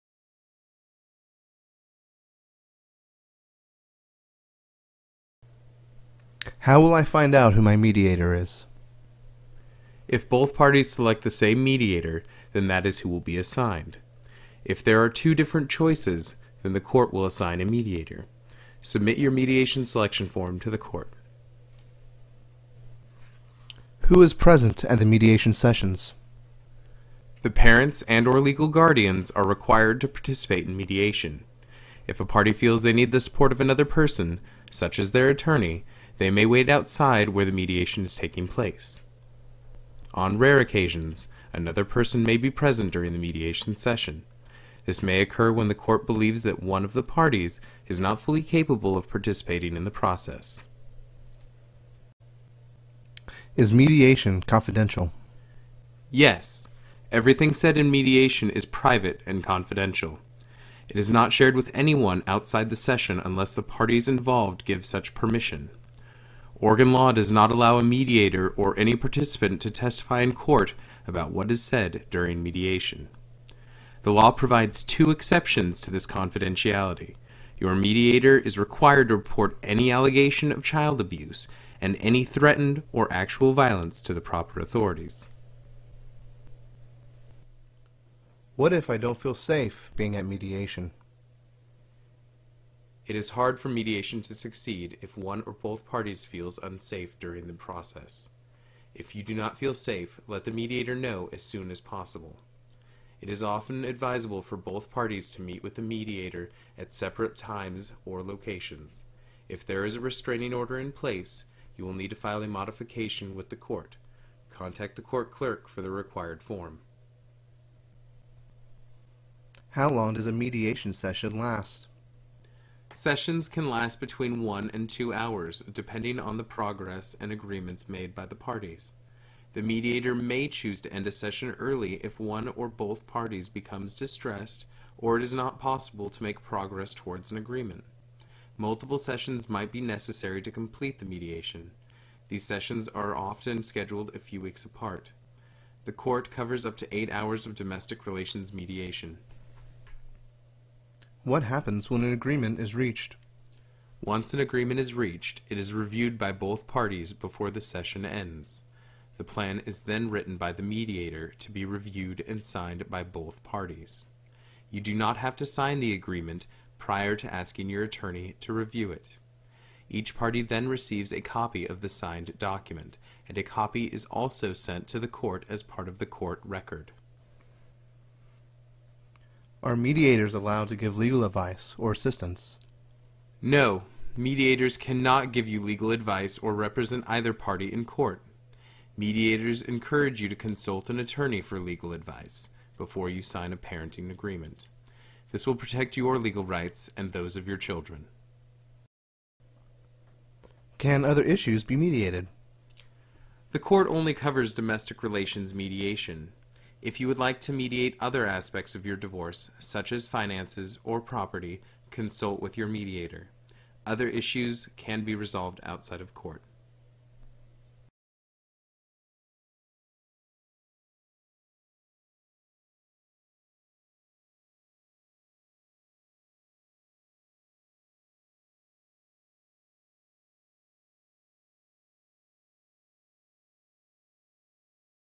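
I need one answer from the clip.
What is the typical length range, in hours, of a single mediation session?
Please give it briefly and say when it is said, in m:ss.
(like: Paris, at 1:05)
1 to 2 hours, at 2:03.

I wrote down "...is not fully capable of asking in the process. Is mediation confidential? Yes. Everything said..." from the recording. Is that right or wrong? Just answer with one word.
wrong.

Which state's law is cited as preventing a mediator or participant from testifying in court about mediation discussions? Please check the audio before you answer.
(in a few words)
Oregon.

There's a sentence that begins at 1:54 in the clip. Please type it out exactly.
Contact the court clerk for the required form.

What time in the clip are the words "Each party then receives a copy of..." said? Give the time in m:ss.
2:49.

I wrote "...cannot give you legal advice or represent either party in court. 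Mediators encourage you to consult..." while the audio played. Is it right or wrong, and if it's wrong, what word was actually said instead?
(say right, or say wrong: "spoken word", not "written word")
right.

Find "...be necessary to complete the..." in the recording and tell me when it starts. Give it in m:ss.
2:19.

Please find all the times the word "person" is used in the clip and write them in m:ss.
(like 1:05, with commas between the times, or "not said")
0:33, 0:41.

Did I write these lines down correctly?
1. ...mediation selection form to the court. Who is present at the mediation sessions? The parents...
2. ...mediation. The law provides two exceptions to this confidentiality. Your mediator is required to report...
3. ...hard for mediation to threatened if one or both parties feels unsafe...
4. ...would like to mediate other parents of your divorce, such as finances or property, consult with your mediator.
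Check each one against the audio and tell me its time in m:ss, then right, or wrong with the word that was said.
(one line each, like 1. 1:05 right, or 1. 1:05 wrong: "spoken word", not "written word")
1. 0:19 right
2. 1:12 right
3. 1:33 wrong: "succeed", not "threatened"
4. 3:27 wrong: "aspects", not "parents".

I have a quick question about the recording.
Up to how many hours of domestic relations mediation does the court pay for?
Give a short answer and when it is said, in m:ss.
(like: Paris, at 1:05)
8, at 2:26.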